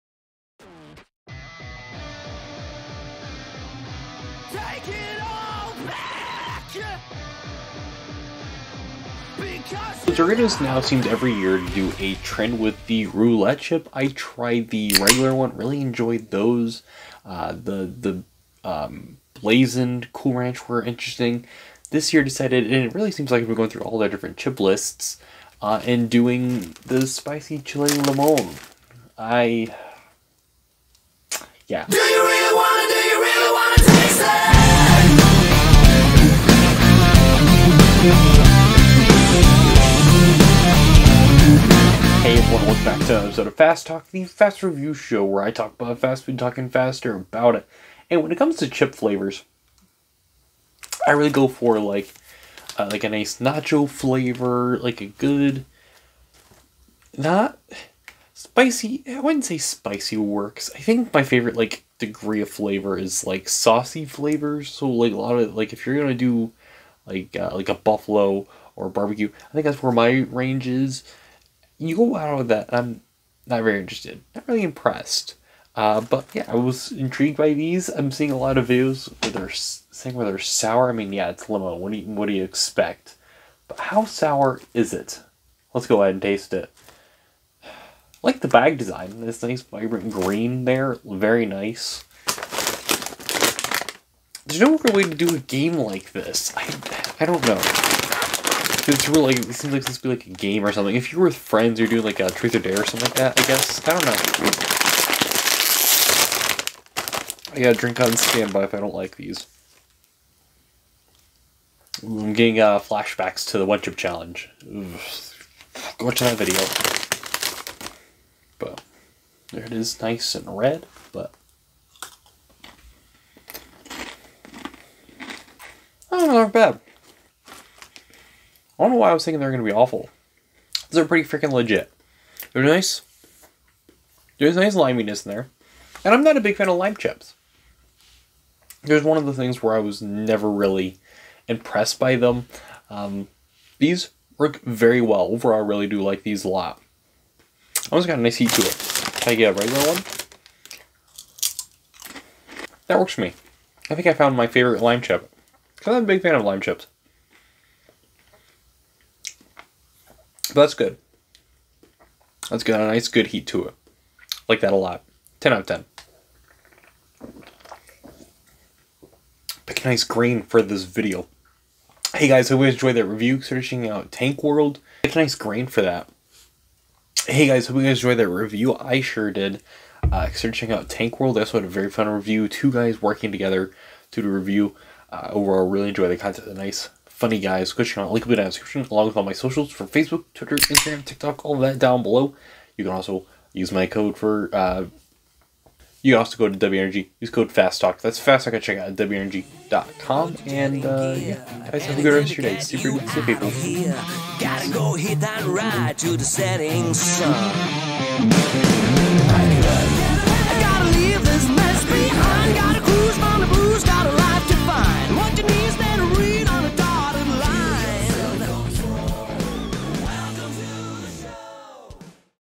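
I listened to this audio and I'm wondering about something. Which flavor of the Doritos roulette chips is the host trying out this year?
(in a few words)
Spicy chili limon.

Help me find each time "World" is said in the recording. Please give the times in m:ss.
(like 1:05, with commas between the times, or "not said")
2:54, 3:01.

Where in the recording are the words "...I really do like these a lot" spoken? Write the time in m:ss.
2:25.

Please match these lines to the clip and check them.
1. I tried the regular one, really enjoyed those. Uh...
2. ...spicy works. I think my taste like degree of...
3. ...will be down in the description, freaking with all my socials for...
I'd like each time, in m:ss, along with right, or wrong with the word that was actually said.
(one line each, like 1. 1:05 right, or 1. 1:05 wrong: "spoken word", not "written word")
1. 0:13 right
2. 0:59 wrong: "favorite", not "taste"
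3. 3:08 wrong: "along", not "freaking".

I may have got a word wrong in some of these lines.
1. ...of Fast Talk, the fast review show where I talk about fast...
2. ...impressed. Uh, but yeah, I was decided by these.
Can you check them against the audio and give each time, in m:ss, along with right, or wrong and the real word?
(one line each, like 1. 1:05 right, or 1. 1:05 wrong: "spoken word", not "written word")
1. 0:43 right
2. 1:14 wrong: "intrigued", not "decided".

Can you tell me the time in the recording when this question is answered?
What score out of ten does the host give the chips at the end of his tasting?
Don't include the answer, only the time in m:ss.
2:45.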